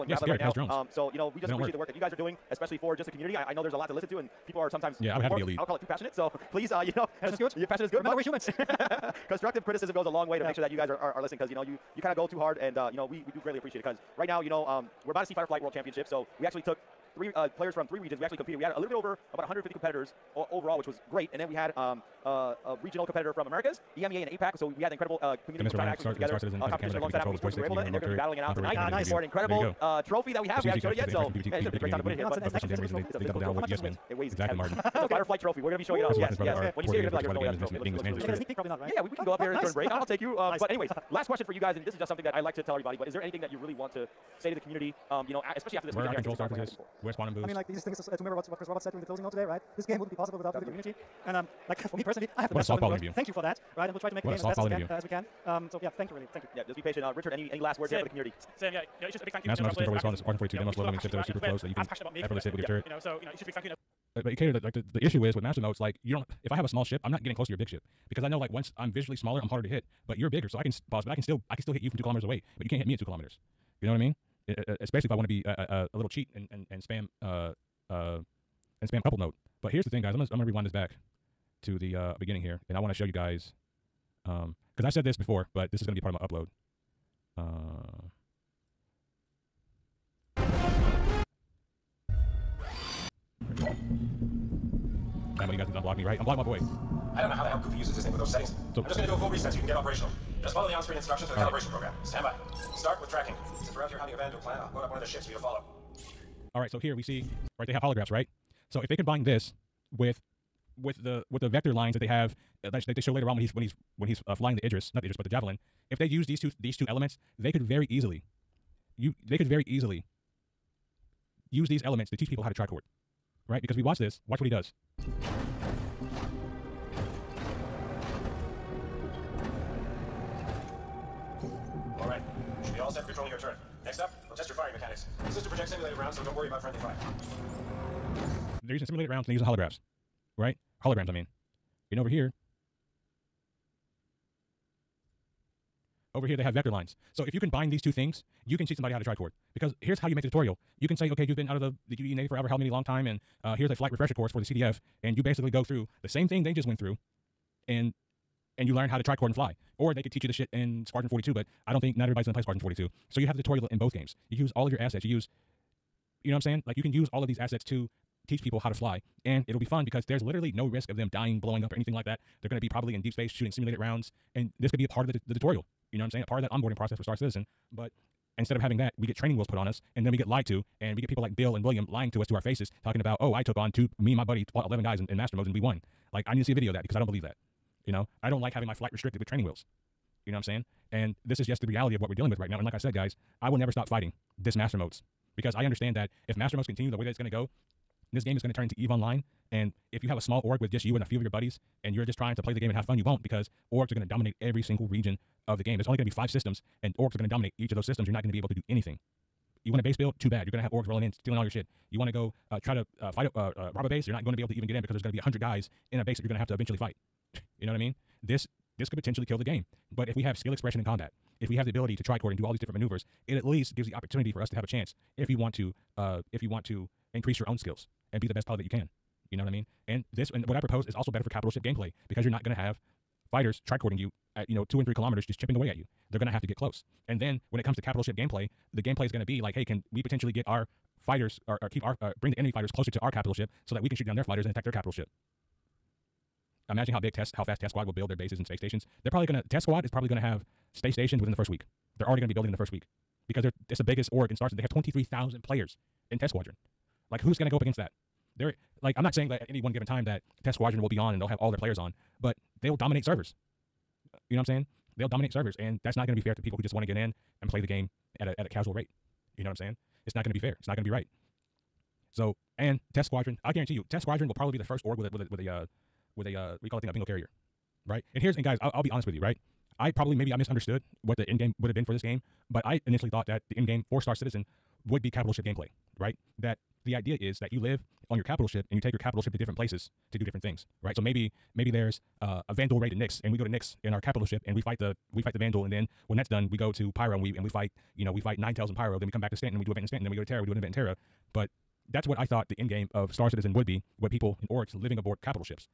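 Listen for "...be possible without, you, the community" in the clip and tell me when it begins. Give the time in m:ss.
0:50.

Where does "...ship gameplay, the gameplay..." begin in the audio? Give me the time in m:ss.
3:58.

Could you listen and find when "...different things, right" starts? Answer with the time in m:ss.
4:50.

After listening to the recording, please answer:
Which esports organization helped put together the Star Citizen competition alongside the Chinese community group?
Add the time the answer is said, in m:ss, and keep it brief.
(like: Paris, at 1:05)
Atmo Esports, at 0:27.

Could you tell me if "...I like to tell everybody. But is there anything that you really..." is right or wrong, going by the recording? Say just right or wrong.
right.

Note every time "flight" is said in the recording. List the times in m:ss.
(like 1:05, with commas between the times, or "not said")
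0:15, 0:35, 2:33, 3:08.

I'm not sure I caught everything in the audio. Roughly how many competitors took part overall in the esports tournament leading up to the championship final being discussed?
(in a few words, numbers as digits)
150.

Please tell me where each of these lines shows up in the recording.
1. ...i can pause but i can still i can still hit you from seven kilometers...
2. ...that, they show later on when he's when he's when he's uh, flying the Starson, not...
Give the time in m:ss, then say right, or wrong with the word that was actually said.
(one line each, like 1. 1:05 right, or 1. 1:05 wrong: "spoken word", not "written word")
1. 1:10 wrong: "two", not "seven"
2. 1:52 wrong: "Idris", not "Starson".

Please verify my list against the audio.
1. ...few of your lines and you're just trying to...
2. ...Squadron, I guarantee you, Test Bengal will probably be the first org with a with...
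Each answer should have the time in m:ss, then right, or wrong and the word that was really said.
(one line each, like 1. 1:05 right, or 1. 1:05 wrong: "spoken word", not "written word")
1. 3:21 wrong: "buddies", not "lines"
2. 4:33 wrong: "Squadron", not "Bengal".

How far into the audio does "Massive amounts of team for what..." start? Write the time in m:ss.
0:59.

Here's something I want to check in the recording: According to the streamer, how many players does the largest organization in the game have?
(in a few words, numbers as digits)
23,000.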